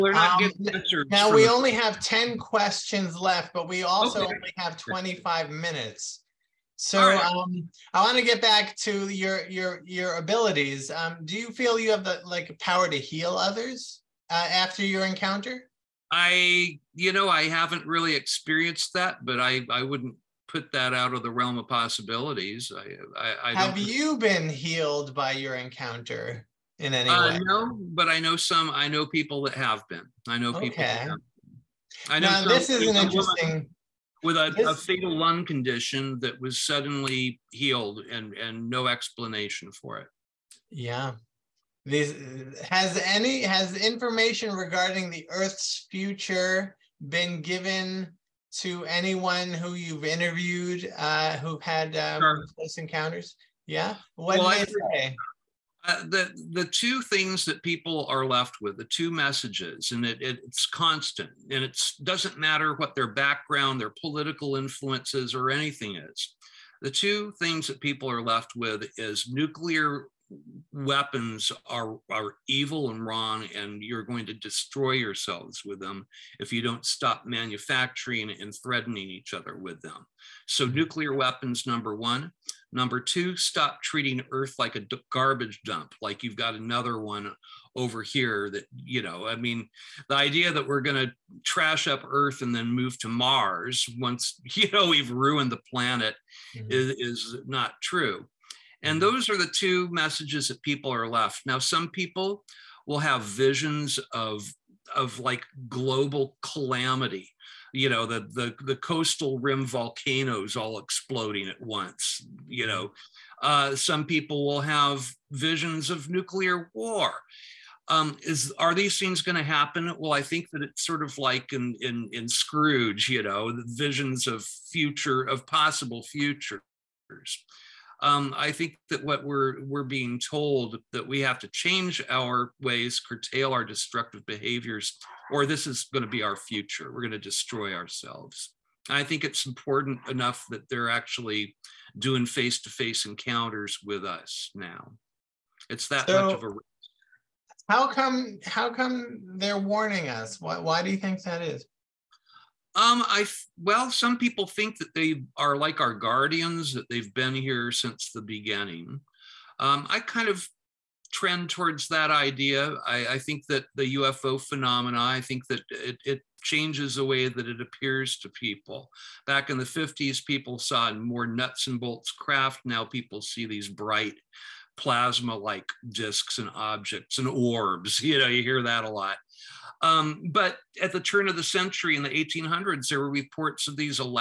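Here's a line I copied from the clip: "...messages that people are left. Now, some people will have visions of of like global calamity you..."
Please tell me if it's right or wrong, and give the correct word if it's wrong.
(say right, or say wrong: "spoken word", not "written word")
right.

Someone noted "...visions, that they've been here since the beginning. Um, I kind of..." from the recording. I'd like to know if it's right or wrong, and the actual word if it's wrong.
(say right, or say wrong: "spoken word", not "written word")
wrong: "guardians", not "visions".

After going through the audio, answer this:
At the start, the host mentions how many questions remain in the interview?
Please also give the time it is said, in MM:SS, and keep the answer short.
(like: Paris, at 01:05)
10, at 00:02.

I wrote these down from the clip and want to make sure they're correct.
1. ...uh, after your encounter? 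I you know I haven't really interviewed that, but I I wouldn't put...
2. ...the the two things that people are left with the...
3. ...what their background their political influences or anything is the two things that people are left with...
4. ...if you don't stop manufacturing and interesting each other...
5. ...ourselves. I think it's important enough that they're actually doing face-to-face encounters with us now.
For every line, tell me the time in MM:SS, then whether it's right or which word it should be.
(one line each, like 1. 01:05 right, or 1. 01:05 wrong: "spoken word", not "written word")
1. 00:14 wrong: "experienced", not "interviewed"
2. 00:56 right
3. 01:02 right
4. 01:16 wrong: "threatening", not "interesting"
5. 02:17 right.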